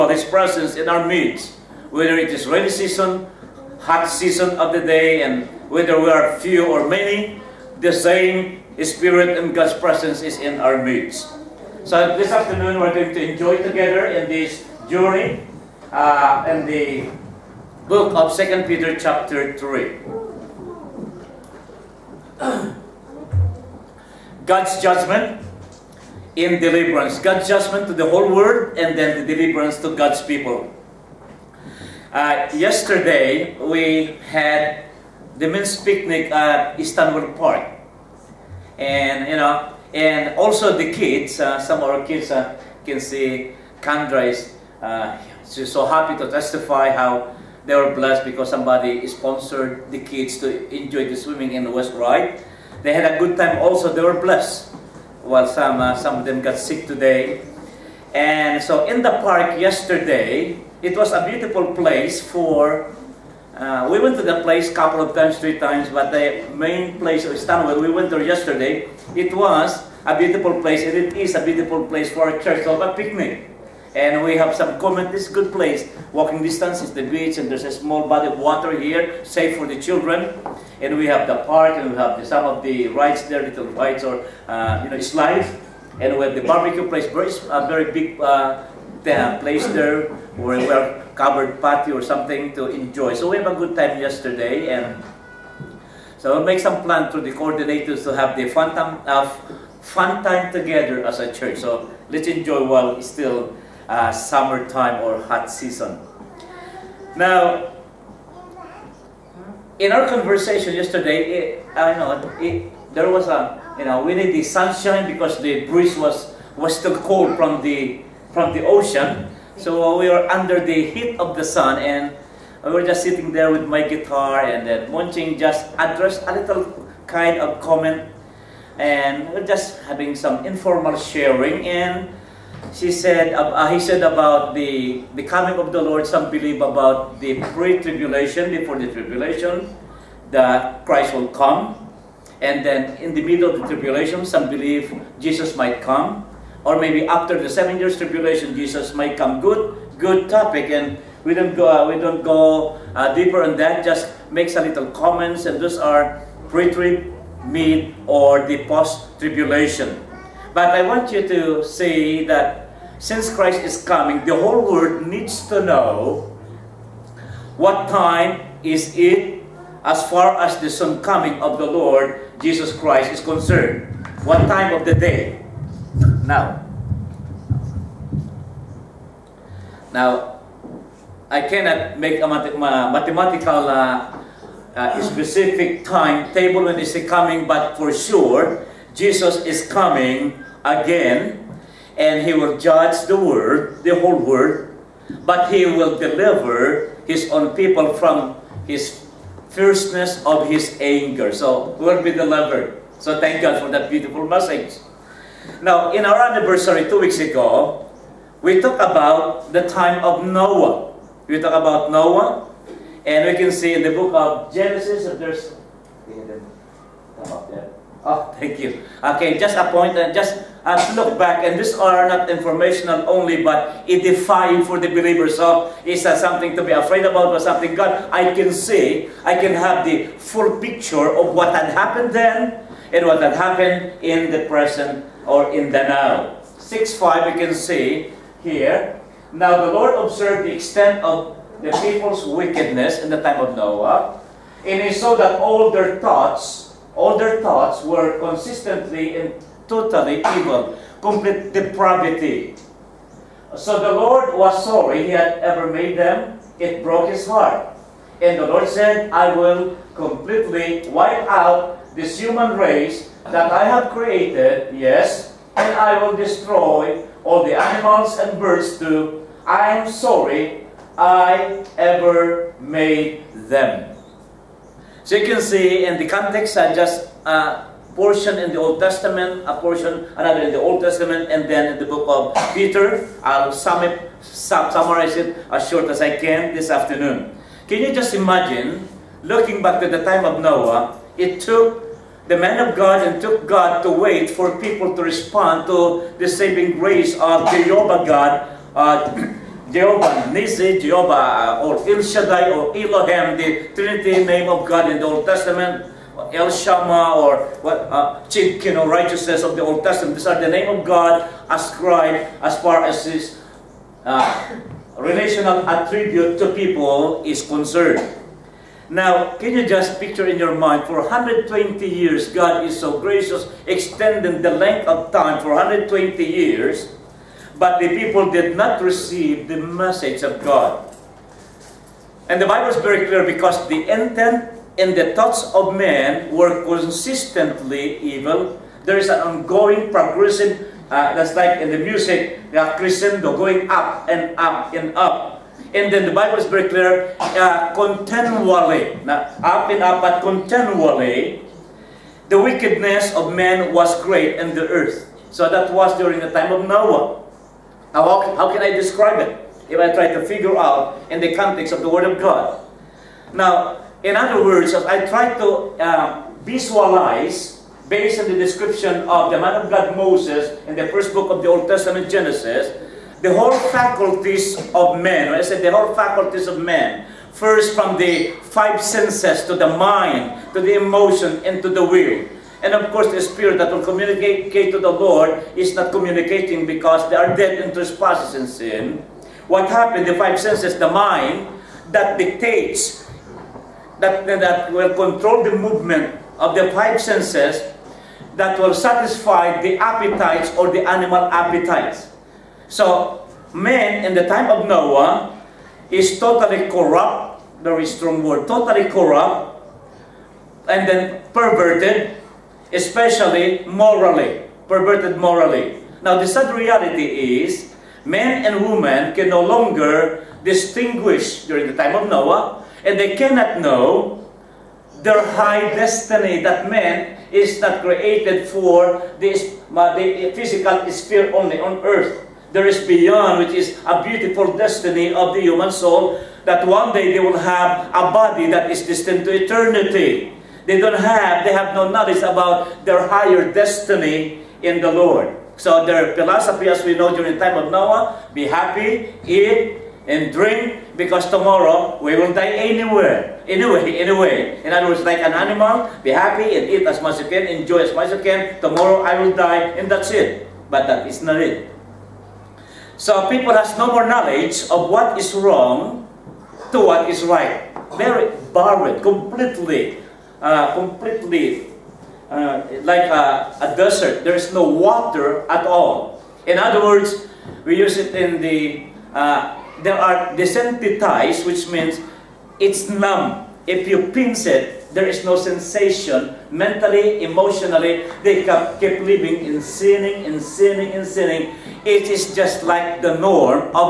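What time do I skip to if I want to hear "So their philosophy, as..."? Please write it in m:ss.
7:25.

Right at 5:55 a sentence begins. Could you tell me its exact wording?
So that was during the time of Noah.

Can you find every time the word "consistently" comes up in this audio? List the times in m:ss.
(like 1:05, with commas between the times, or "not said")
4:08, 5:36.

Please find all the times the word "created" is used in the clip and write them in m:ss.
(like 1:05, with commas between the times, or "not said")
4:23, 7:07.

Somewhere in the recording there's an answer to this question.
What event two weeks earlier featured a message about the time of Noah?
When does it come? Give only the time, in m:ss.
3:26.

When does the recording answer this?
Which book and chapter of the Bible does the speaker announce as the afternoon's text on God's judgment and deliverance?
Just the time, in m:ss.
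0:18.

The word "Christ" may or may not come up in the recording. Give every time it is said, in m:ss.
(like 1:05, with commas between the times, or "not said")
2:20, 2:43, 2:52.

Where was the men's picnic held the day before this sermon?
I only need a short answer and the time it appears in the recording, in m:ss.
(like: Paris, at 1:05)
Stanwell Park, at 0:36.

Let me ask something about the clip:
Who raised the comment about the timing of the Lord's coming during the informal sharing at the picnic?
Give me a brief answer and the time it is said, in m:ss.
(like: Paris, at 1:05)
Monching, at 2:04.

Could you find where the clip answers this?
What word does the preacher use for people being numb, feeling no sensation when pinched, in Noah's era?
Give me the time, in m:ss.
8:00.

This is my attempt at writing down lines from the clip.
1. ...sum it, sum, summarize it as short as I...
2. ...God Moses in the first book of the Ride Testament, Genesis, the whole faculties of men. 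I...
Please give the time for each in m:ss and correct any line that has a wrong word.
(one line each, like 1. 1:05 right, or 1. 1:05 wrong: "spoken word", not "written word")
1. 4:43 right
2. 6:09 wrong: "Old", not "Ride".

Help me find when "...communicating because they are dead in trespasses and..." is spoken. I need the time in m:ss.
6:25.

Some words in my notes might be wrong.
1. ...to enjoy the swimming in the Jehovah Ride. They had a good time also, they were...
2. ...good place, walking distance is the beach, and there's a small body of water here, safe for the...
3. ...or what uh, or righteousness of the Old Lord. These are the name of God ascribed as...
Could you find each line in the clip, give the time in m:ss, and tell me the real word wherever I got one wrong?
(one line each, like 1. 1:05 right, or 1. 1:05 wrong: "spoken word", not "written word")
1. 0:50 wrong: "West", not "Jehovah"
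2. 1:15 right
3. 5:07 wrong: "Testament", not "Lord".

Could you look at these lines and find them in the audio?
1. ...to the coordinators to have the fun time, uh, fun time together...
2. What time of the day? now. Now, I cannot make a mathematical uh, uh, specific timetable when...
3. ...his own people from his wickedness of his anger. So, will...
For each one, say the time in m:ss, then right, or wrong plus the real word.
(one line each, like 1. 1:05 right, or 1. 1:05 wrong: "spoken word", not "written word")
1. 1:37 right
2. 2:54 right
3. 3:17 wrong: "fierceness", not "wickedness".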